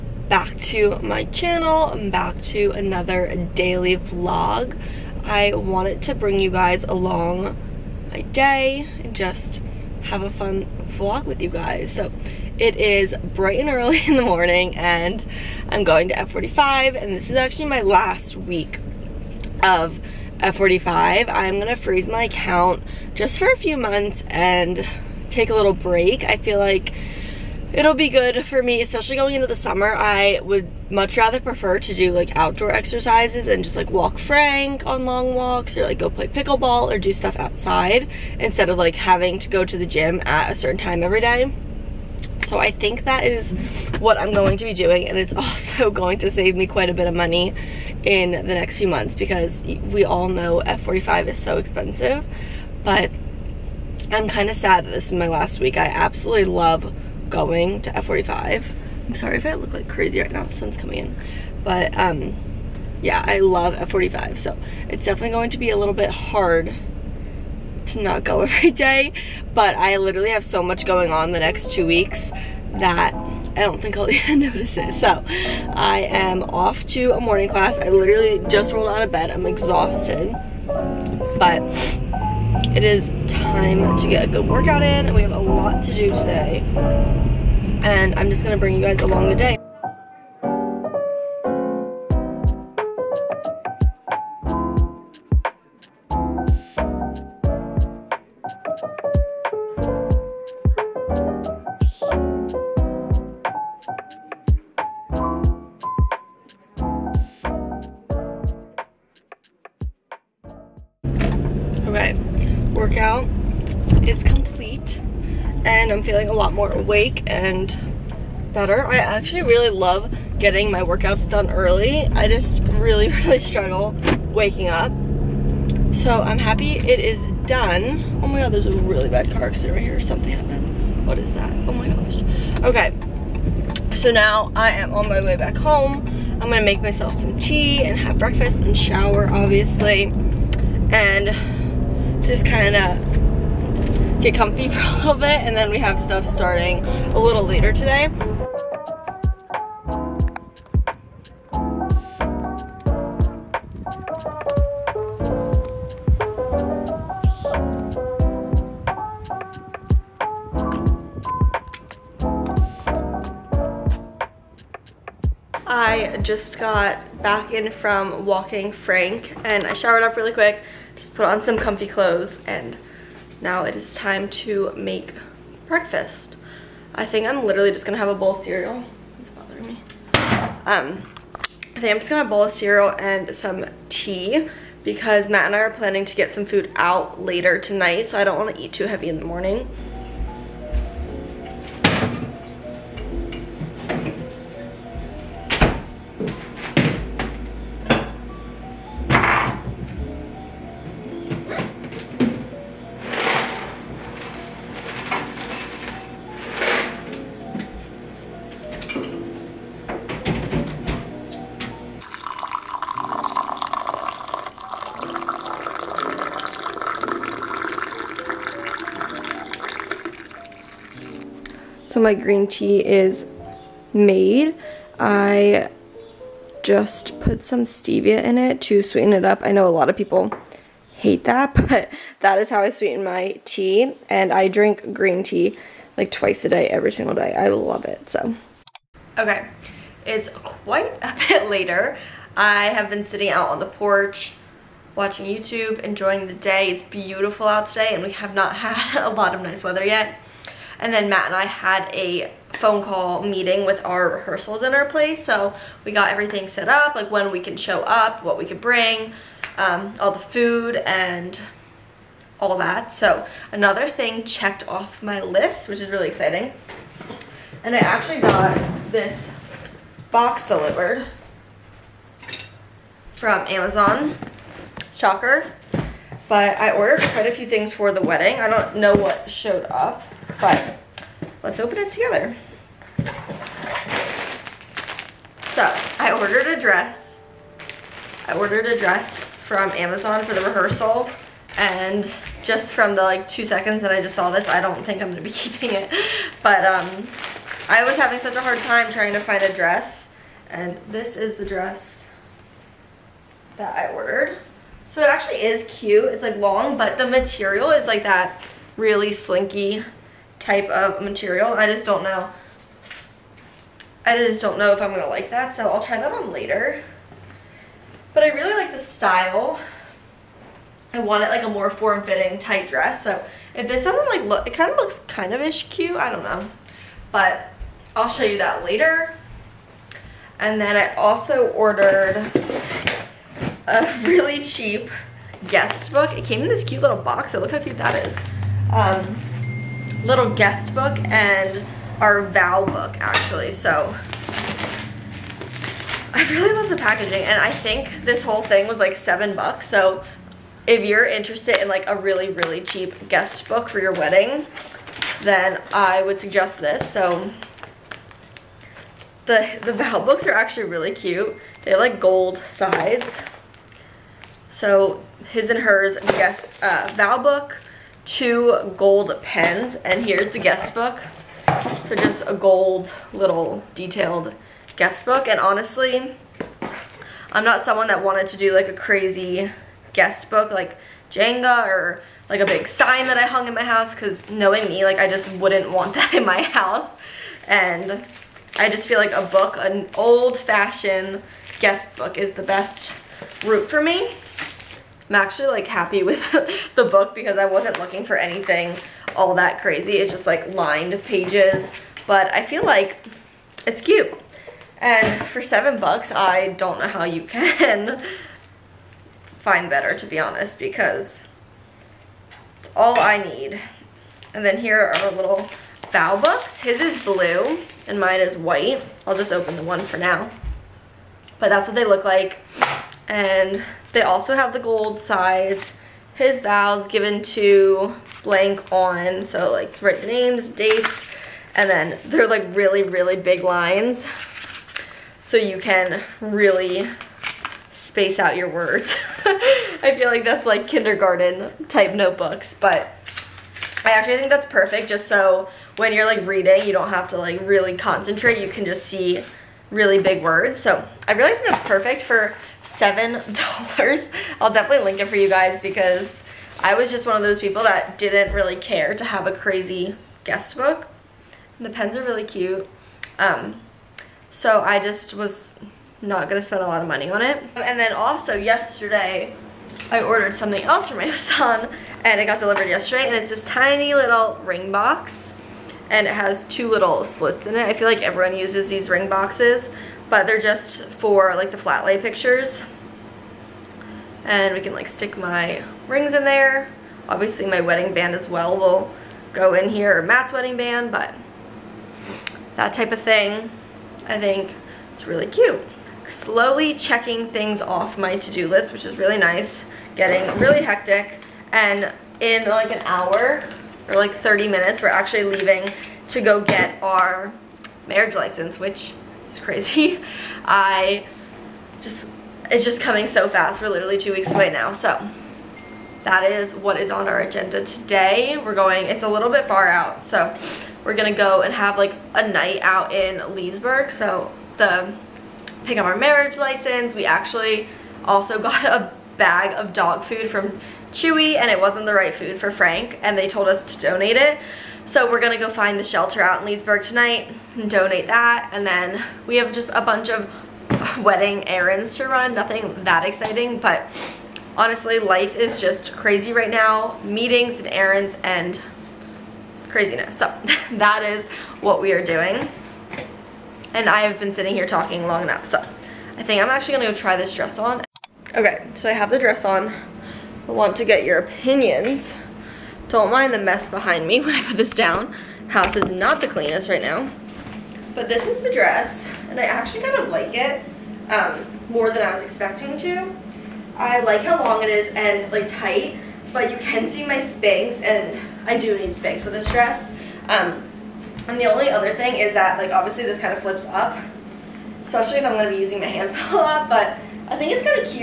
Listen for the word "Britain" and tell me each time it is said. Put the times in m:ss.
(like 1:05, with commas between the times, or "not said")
not said.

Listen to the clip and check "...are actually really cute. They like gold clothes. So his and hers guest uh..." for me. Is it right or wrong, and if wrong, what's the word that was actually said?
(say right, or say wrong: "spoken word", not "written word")
wrong: "sides", not "clothes".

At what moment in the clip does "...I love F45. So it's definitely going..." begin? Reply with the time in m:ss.
1:03.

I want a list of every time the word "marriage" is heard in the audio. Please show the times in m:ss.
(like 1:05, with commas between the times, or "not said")
8:27, 8:45.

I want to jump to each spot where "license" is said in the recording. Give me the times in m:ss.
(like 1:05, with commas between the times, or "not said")
8:28, 8:46.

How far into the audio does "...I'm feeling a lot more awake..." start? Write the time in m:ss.
1:55.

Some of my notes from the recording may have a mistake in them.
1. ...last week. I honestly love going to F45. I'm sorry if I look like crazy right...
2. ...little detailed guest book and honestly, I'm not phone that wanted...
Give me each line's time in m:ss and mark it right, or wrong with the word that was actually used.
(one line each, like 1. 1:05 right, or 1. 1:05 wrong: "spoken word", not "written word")
1. 0:55 wrong: "absolutely", not "honestly"
2. 6:13 wrong: "someone", not "phone".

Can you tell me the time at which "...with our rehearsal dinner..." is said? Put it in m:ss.
4:13.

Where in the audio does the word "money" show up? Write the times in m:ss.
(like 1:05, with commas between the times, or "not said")
0:47, 7:46.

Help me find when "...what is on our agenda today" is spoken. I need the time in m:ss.
8:36.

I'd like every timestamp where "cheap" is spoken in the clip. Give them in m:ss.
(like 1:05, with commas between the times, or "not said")
5:34, 5:52.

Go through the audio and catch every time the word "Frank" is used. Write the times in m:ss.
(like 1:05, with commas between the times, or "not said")
0:34, 2:48, 8:52.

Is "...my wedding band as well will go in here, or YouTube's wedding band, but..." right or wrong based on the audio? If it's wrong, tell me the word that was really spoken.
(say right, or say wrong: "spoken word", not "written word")
wrong: "Matt", not "YouTube".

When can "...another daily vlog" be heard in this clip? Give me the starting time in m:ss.
0:02.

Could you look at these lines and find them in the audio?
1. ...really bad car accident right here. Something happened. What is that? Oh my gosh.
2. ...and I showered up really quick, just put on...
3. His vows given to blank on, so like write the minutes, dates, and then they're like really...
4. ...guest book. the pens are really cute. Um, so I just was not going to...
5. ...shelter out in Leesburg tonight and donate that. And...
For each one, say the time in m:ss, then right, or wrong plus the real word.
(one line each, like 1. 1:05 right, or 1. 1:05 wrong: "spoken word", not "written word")
1. 2:08 right
2. 2:49 right
3. 7:06 wrong: "names", not "minutes"
4. 7:40 right
5. 8:55 right.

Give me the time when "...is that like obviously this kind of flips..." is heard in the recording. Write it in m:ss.
9:42.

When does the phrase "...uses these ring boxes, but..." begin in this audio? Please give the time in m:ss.
7:58.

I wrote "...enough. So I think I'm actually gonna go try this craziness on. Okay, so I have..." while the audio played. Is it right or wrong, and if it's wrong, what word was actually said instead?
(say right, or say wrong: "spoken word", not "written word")
wrong: "dress", not "craziness".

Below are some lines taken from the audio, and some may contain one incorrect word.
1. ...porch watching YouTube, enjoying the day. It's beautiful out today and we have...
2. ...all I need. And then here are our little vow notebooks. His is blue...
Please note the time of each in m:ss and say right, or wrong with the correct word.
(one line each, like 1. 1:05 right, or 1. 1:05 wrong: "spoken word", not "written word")
1. 4:03 right
2. 6:52 wrong: "books", not "notebooks".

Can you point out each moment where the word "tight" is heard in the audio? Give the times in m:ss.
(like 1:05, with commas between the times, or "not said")
5:22, 9:35.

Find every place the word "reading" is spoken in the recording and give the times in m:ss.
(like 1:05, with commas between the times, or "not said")
7:26.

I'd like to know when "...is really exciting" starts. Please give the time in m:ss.
4:25.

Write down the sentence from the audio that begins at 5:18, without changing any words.
But I really like the style.